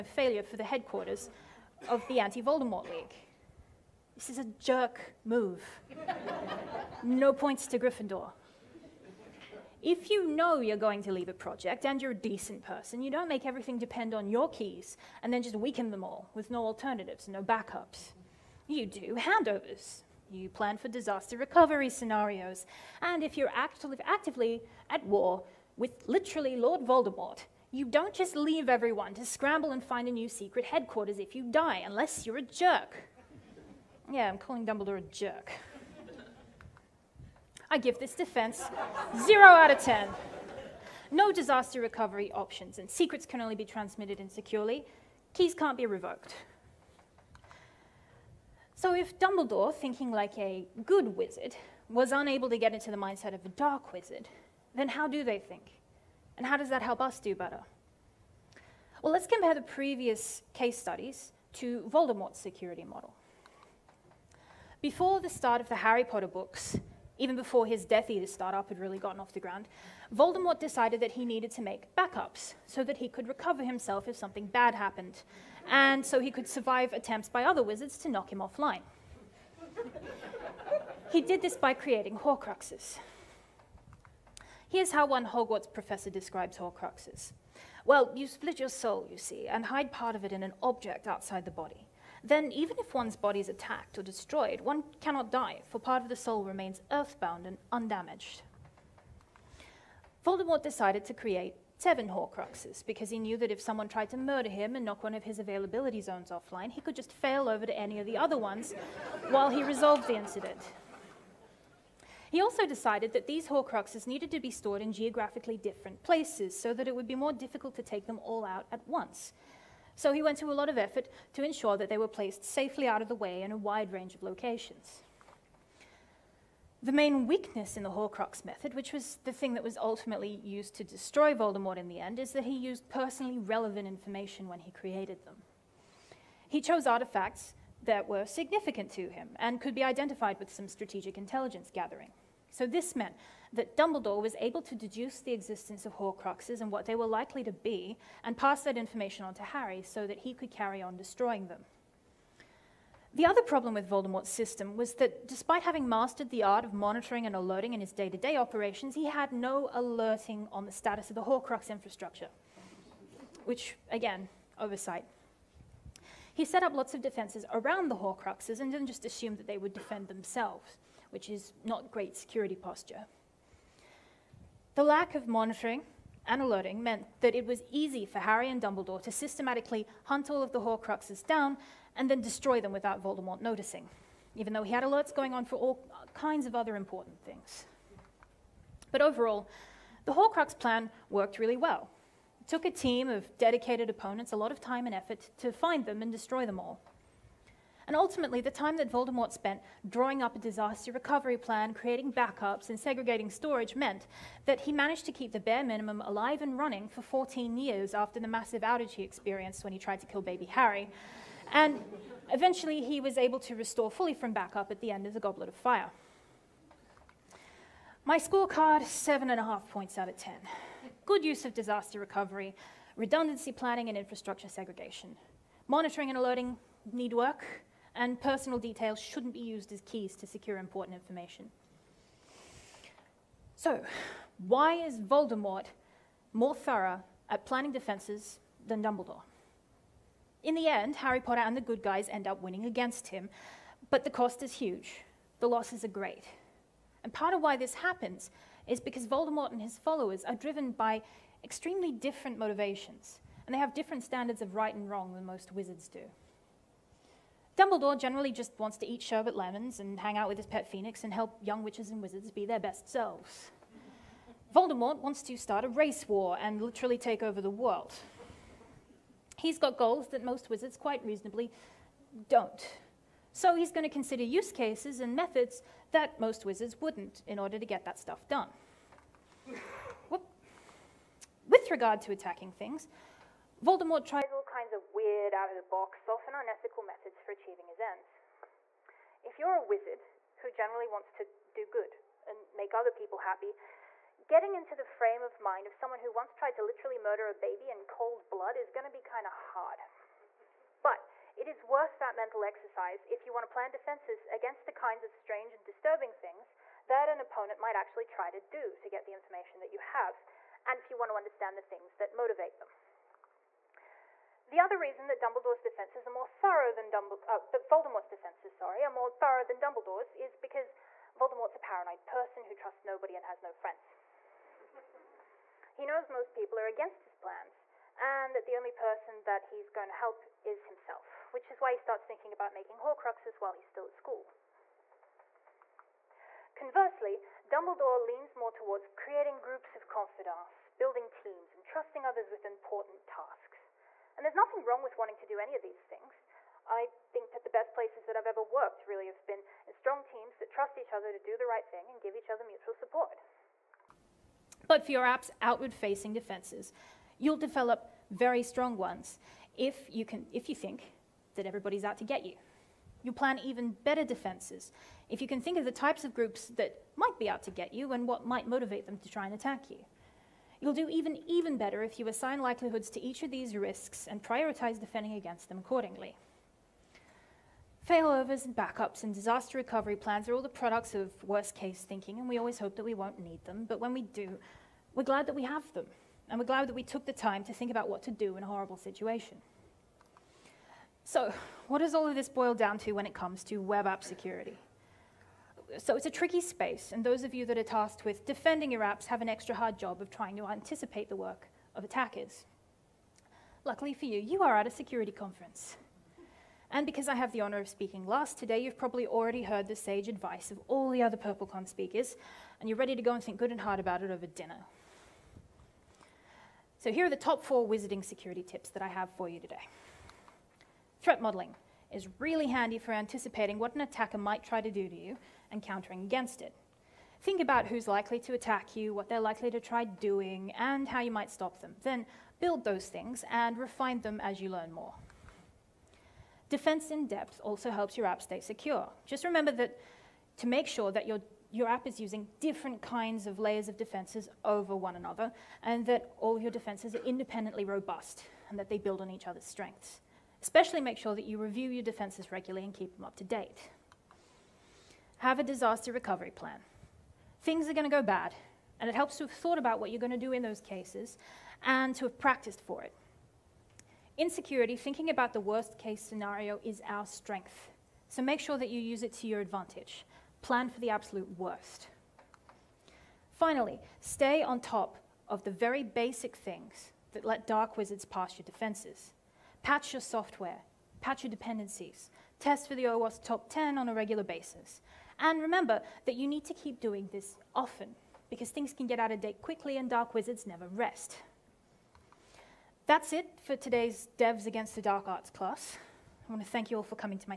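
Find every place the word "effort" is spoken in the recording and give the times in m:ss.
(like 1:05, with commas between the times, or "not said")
2:00, 3:14.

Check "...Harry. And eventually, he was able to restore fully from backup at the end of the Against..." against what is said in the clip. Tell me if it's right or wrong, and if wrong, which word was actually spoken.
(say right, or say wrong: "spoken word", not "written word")
wrong: "Goblet", not "Against".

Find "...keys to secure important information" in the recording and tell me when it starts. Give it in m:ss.
3:49.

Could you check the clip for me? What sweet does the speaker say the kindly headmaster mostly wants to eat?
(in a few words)
Sherbet lemons.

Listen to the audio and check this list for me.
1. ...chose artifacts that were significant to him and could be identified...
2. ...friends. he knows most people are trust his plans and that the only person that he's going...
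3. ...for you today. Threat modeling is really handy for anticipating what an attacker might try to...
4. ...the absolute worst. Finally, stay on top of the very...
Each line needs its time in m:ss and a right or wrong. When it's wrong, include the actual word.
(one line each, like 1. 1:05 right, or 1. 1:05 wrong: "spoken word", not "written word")
1. 2:16 right
2. 5:23 wrong: "against", not "trust"
3. 6:59 right
4. 7:50 right.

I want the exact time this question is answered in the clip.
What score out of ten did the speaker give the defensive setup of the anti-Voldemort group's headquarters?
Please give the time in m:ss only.
0:39.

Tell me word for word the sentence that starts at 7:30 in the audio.
Especially make sure that you review your defenses regularly and keep them up to date have a disaster recovery plan.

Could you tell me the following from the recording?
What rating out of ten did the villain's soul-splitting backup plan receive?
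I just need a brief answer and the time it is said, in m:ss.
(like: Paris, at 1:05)
7.5, at 3:38.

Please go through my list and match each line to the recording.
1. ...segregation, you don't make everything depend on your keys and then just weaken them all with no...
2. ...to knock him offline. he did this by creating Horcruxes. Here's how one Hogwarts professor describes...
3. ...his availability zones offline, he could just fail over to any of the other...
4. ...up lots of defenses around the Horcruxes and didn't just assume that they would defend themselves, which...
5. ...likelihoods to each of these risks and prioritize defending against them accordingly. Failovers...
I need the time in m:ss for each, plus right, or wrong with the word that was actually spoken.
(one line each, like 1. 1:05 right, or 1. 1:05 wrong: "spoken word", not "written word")
1. 0:12 wrong: "person", not "segregation"
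2. 1:17 right
3. 1:45 right
4. 2:46 right
5. 6:12 right.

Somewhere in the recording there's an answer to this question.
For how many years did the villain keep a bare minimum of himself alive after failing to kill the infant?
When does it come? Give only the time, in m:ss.
3:27.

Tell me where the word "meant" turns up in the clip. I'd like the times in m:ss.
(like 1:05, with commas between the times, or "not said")
2:22, 2:56, 3:23.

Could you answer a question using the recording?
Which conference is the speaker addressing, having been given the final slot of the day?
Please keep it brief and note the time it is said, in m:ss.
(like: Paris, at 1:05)
PurpleCon, at 6:51.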